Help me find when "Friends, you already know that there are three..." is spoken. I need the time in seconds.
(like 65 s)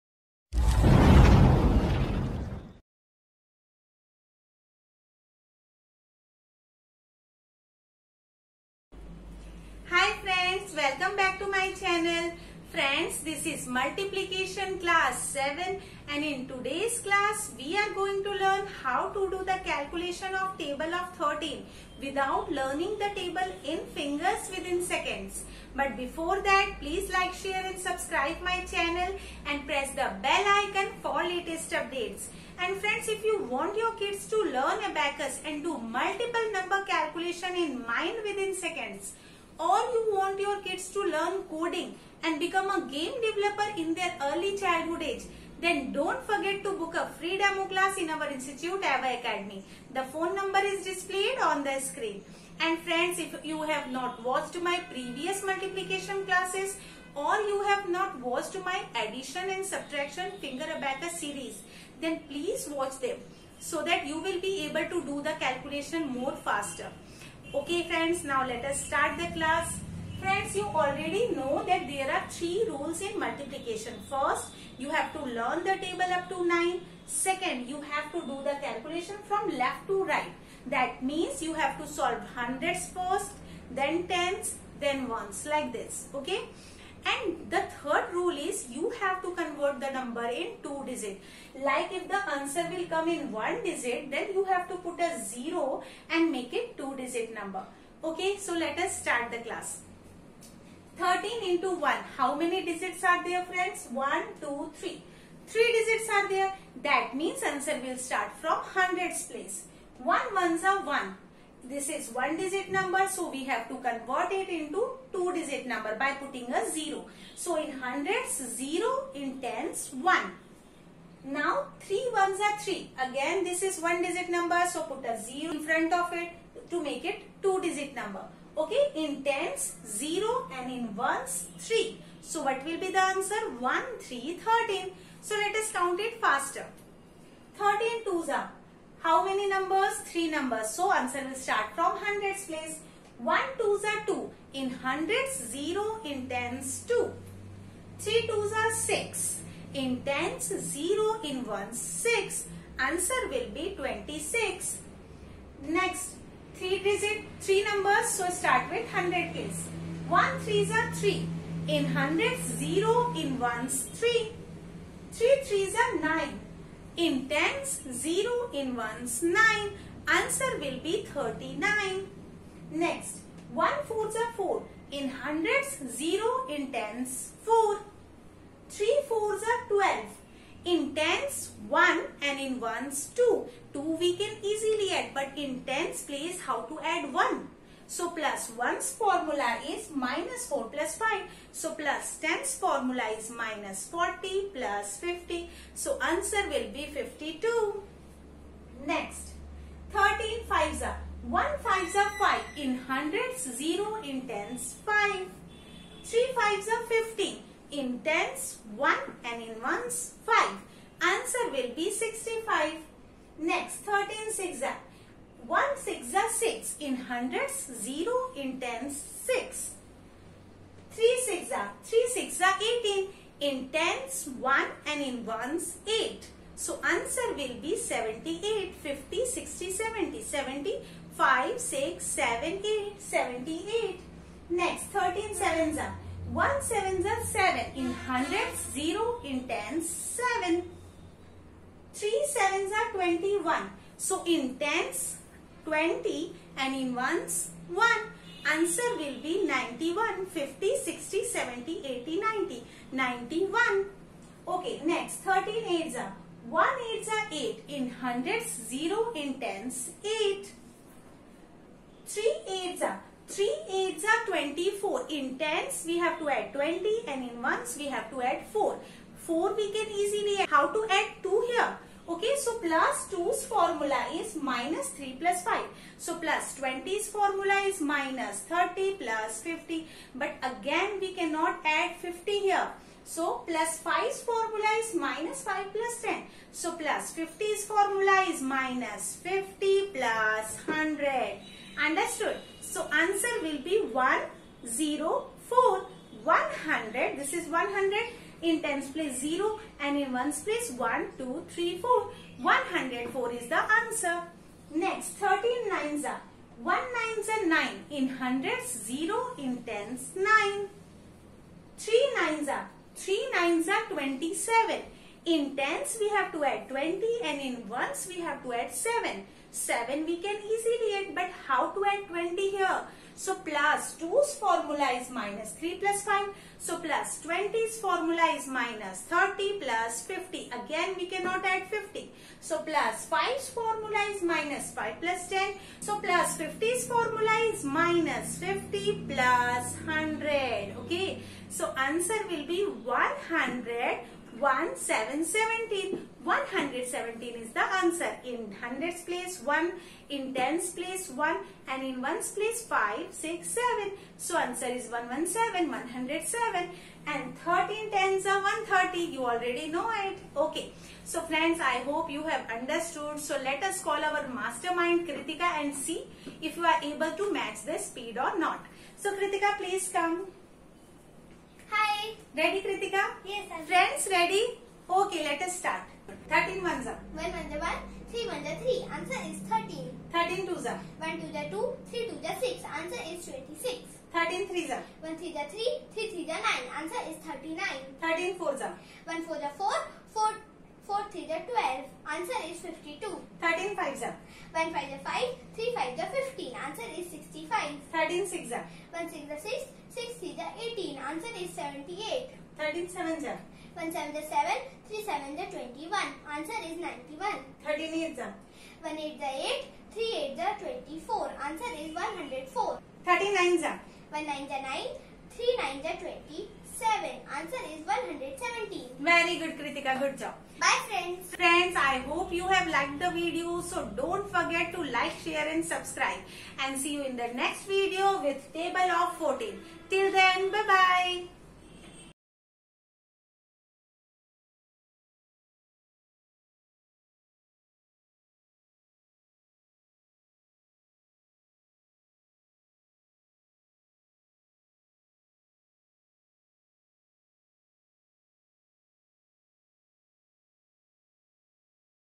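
70 s.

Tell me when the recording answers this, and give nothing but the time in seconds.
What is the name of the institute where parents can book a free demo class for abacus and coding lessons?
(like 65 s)
48 s.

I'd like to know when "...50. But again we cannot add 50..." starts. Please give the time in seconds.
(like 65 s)
279 s.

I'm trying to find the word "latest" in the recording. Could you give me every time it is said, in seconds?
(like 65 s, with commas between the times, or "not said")
31 s.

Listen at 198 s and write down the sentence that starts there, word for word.
Next, 13 fives are 1 fives are 5 in hundreds 0 in tens 5.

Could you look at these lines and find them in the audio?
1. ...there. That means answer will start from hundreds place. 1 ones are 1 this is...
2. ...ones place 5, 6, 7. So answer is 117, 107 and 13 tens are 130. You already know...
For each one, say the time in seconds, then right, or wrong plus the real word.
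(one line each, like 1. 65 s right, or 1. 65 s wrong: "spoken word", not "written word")
1. 106 s right
2. 352 s right.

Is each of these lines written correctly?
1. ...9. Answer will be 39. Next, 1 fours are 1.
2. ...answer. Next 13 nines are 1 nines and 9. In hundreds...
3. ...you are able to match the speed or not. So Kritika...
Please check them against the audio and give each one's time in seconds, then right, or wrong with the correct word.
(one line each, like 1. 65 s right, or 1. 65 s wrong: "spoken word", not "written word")
1. 169 s wrong: "4", not "1"
2. 303 s right
3. 366 s right.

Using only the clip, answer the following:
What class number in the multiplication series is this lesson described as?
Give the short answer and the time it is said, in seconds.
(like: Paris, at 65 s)
7, at 13 s.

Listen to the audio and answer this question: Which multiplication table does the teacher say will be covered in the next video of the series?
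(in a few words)
14.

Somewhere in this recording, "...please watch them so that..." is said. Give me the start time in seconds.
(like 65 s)
62 s.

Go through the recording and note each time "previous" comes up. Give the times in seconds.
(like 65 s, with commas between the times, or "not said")
54 s.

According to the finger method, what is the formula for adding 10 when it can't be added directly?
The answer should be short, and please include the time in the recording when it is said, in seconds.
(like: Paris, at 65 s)
minus 40 plus 50, at 193 s.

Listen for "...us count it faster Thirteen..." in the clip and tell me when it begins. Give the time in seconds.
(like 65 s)
135 s.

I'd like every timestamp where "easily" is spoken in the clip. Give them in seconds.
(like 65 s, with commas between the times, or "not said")
184 s, 269 s, 320 s.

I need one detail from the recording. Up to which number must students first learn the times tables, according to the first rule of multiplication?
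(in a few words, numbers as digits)
9.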